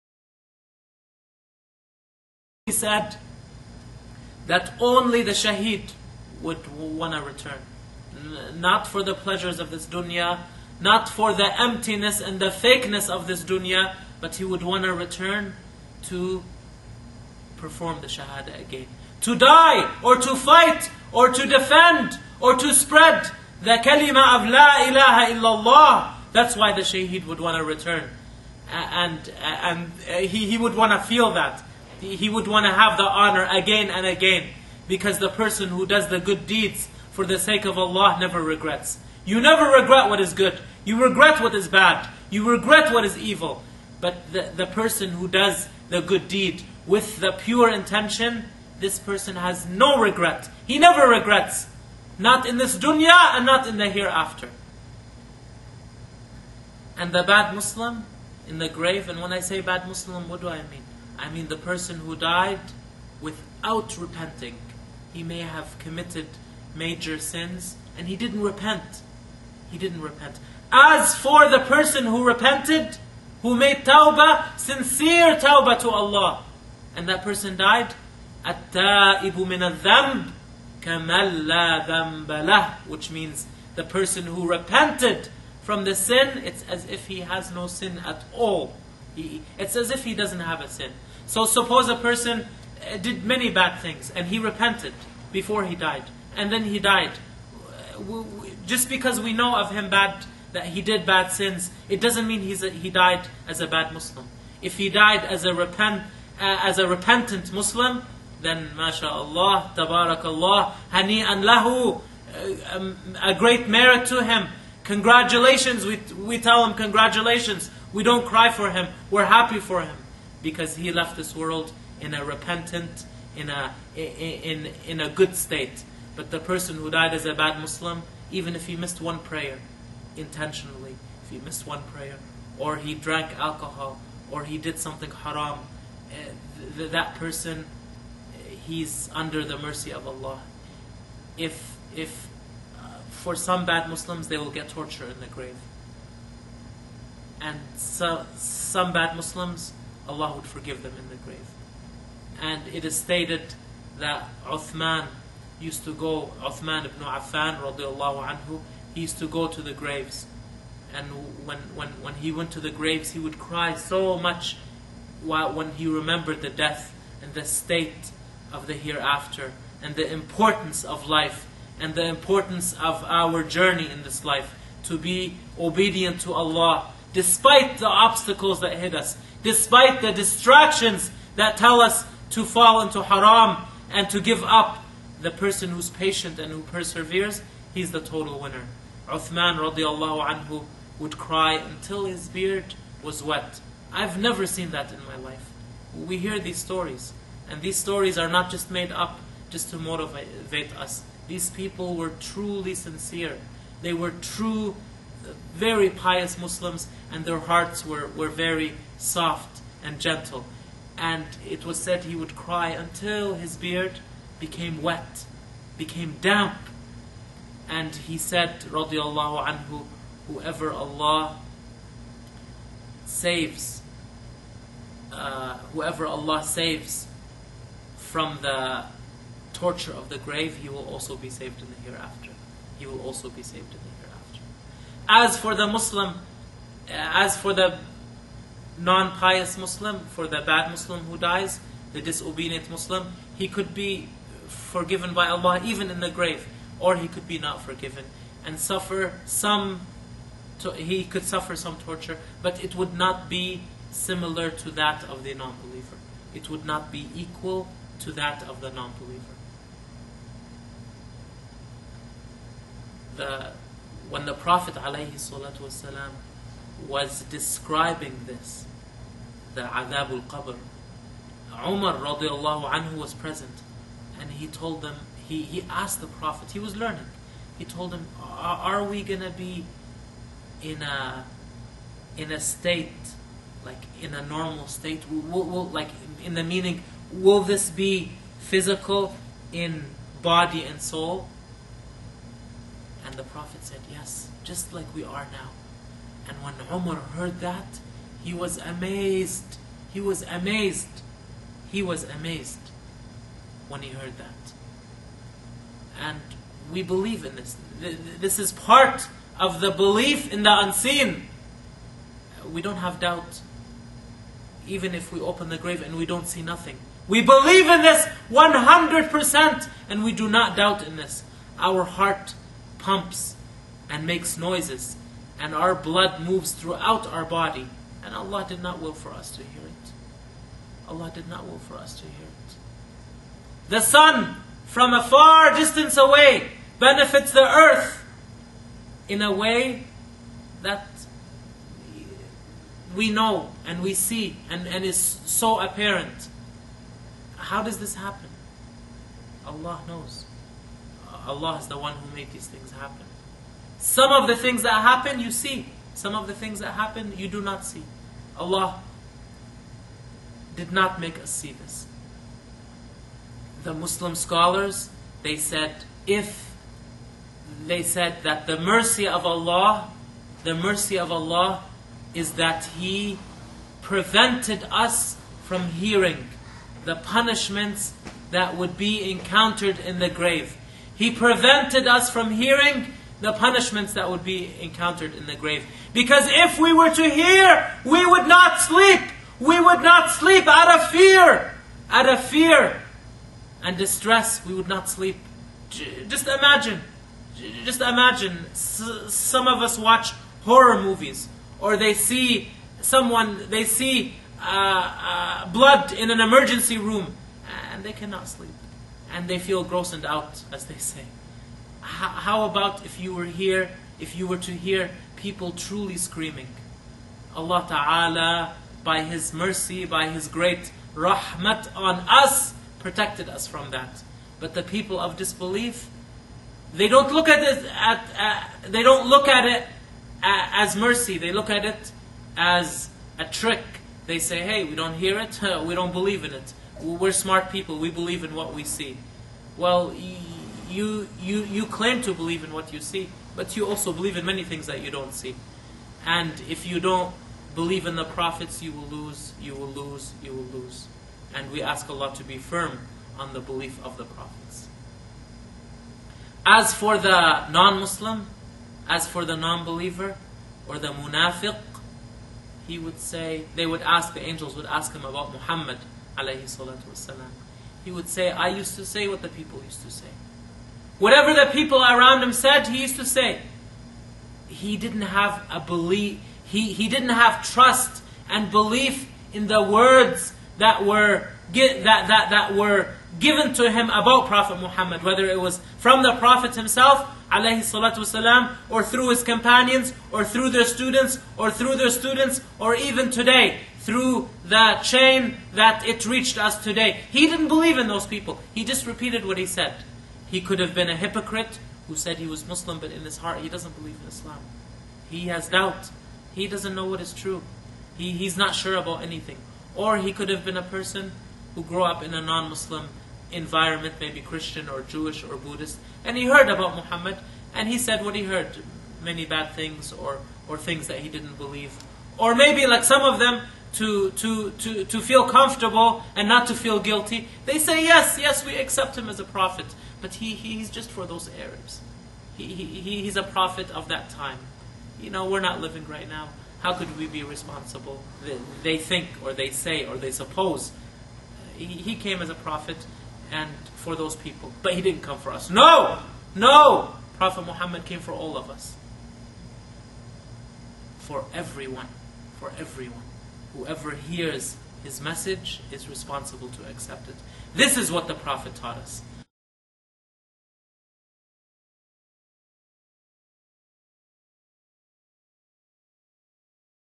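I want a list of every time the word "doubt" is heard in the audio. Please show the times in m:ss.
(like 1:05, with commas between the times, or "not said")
5:12, 5:20, 8:25.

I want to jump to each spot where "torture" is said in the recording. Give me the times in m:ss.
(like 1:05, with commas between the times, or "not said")
2:24, 3:49, 4:11.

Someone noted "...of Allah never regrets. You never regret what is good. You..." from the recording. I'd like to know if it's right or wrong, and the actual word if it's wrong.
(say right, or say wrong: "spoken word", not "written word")
right.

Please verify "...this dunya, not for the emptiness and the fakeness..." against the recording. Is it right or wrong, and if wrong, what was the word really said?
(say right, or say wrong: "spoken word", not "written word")
right.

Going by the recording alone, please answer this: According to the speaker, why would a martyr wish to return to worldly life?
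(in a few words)
to perform the shahada again.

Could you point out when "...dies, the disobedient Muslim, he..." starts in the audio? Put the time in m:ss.
4:01.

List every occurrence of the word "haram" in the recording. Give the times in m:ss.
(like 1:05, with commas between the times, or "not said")
2:15, 3:03.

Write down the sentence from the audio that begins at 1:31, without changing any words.
So suppose a person eh, did many bad things and he repented before he died, and then he died.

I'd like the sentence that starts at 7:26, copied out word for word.
And if you don't believe in the prophets, you will lose, you will lose, you will lose.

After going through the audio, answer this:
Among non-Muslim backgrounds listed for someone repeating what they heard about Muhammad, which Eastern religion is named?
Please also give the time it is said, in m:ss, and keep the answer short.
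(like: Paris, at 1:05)
Buddhist, at 8:35.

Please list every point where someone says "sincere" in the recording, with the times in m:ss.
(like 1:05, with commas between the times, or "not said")
1:14, 3:22.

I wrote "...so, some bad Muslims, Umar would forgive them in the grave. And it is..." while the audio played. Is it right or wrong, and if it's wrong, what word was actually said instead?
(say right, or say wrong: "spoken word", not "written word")
wrong: "Allah", not "Umar".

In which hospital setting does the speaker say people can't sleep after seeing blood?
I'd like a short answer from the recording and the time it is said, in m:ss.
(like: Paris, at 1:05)
emergency room, at 6:46.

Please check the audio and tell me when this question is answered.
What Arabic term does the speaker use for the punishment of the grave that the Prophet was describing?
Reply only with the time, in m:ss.
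4:29.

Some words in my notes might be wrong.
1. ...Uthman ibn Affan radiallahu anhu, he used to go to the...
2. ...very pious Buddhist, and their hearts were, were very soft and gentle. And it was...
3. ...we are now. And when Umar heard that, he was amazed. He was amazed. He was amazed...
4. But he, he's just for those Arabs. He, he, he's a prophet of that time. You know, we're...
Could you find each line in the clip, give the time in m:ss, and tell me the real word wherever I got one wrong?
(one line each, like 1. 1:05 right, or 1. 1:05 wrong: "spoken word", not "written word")
1. 2:36 right
2. 3:25 wrong: "Muslims", not "Buddhist"
3. 4:54 right
4. 8:50 right.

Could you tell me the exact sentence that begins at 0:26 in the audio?
That's why the shaheed would want to return.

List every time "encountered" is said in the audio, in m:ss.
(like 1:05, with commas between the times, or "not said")
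6:19, 6:24.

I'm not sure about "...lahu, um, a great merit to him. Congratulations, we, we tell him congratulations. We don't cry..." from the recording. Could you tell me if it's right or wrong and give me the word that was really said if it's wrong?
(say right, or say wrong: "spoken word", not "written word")
right.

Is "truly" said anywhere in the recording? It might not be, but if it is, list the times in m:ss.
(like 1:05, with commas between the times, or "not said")
3:22, 6:55.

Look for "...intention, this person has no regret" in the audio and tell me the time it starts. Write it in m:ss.
0:47.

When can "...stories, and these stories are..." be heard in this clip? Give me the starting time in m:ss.
3:16.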